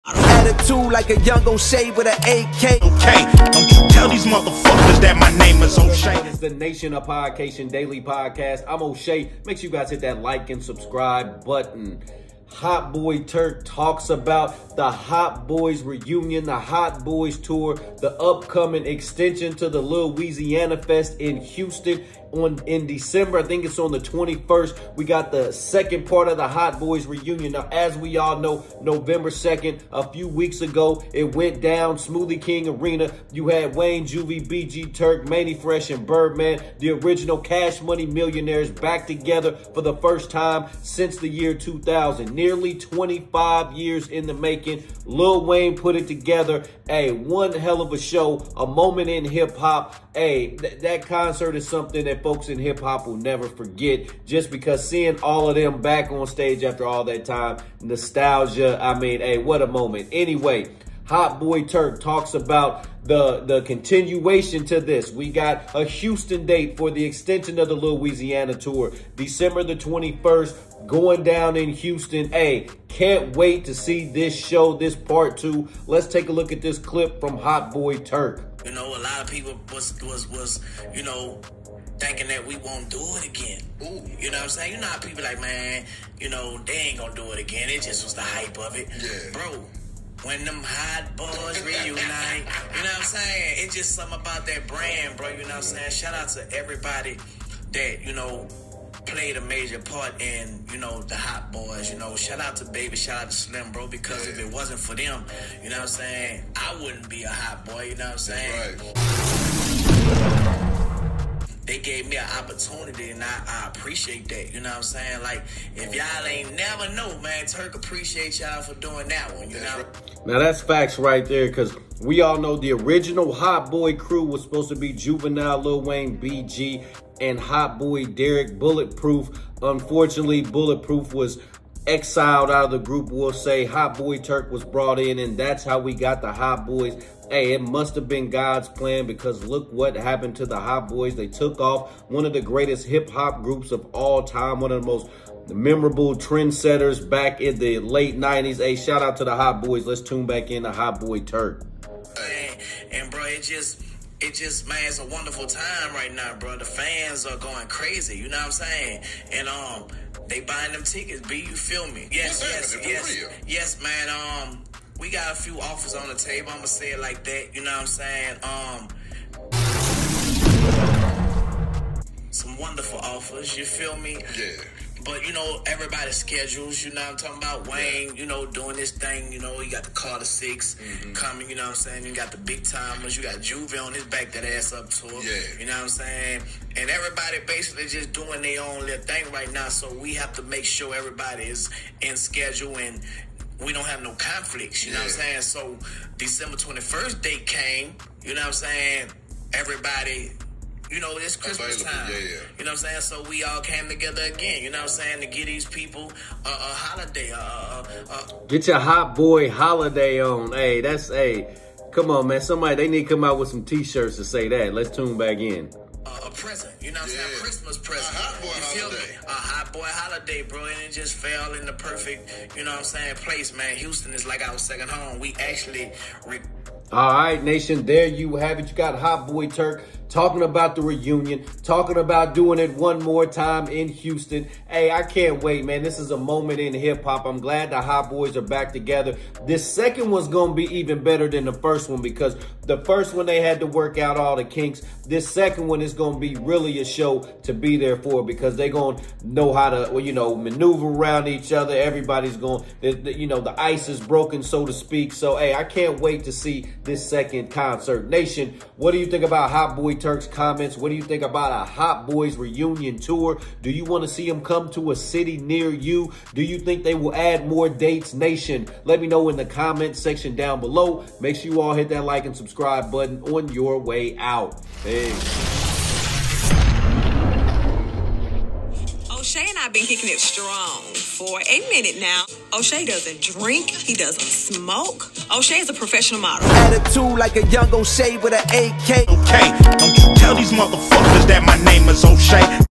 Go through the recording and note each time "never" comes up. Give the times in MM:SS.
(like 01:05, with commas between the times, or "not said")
00:53, 01:56.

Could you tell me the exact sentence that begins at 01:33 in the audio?
It's just something about that brand, bro.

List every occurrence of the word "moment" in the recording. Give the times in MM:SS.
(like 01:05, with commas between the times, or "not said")
00:48, 00:59, 03:56.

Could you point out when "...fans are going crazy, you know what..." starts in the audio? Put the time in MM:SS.
02:36.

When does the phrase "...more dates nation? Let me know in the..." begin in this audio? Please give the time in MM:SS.
04:27.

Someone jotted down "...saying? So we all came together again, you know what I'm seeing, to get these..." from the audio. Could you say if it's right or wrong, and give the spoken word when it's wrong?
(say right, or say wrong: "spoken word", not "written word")
wrong: "saying", not "seeing".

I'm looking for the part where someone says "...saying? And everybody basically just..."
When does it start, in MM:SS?
03:05.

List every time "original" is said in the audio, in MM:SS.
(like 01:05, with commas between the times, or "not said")
00:36, 02:02.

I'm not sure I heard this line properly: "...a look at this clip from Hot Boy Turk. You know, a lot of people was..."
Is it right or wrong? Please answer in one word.
right.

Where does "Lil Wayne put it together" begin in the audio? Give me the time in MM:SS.
00:45.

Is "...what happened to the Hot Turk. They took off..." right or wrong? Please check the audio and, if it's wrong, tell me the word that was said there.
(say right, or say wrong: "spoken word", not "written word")
wrong: "Boys", not "Turk".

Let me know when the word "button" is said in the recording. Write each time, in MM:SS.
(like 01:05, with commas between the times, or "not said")
00:11, 04:32.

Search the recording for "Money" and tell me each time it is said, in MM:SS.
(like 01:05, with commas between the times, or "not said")
00:37.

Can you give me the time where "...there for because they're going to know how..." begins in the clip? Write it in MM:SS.
04:07.